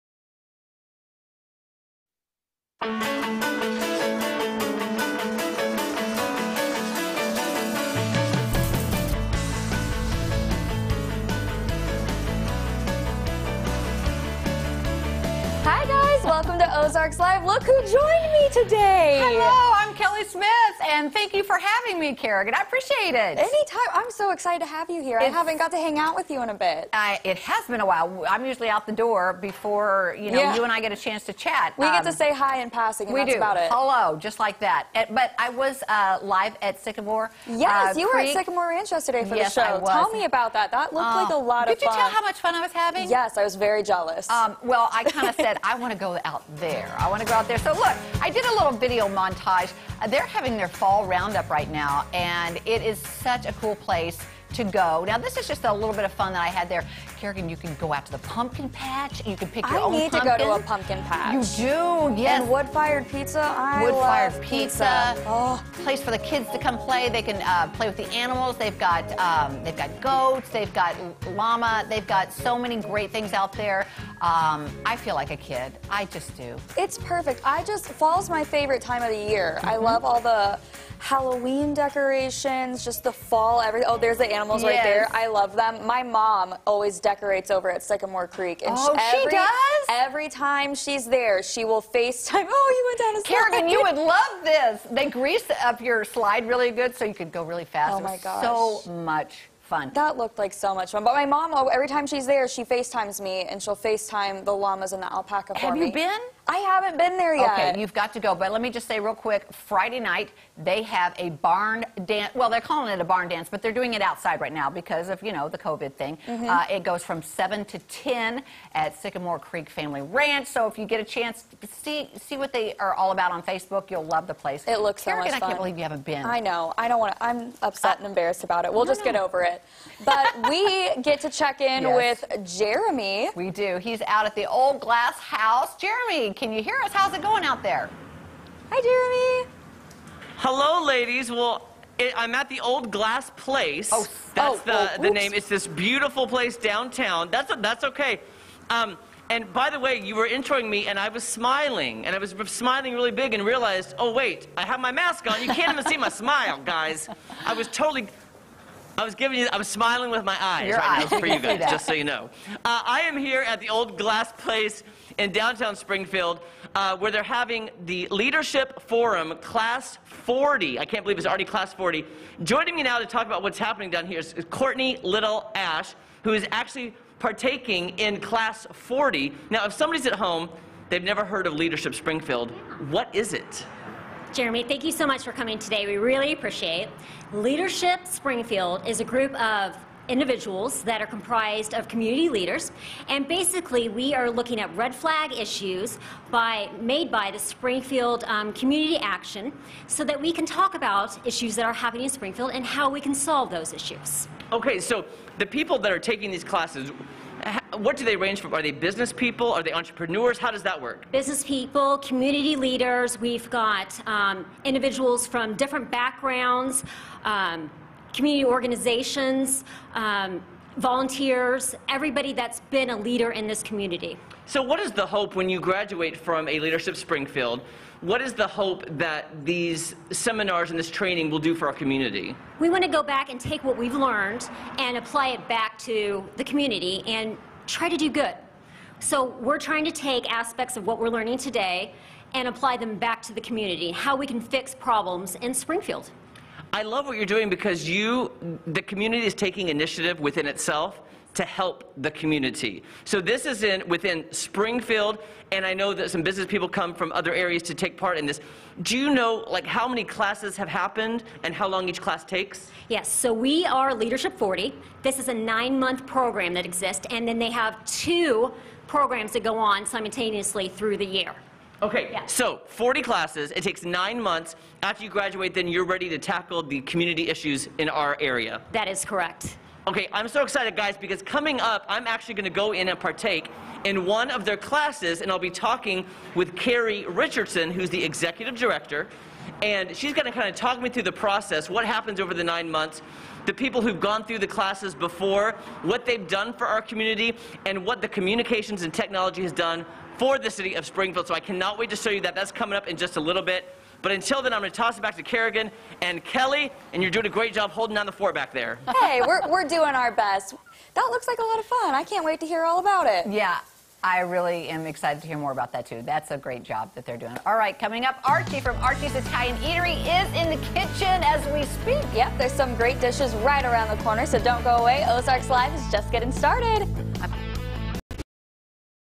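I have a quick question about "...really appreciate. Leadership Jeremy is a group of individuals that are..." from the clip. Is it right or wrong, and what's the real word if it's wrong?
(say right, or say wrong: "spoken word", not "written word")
wrong: "Springfield", not "Jeremy".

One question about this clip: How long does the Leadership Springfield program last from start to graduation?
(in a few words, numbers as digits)
9 months.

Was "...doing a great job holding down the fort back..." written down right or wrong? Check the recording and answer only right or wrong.
right.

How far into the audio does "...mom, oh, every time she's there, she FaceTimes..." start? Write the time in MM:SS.
01:41.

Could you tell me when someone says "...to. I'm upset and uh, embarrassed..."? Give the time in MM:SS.
02:07.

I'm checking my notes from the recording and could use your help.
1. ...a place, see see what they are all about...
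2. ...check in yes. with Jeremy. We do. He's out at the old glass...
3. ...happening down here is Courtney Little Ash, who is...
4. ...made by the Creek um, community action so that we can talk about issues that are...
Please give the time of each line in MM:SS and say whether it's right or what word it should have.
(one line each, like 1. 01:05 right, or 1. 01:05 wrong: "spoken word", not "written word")
1. 02:00 wrong: "chance", not "place"
2. 02:11 right
3. 02:53 right
4. 03:16 wrong: "Springfield", not "Creek".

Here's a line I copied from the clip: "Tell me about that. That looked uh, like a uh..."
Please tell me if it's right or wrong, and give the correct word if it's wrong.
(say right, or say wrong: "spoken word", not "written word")
right.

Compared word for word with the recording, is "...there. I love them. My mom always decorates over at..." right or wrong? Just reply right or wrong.
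right.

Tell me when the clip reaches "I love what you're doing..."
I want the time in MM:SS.
04:06.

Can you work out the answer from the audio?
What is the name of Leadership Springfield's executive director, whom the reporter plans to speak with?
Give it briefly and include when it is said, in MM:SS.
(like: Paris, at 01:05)
Carrie Richardson, at 04:46.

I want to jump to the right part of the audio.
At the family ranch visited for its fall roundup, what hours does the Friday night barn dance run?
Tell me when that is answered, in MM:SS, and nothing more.
01:57.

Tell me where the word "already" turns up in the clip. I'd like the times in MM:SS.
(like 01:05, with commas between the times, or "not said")
02:51.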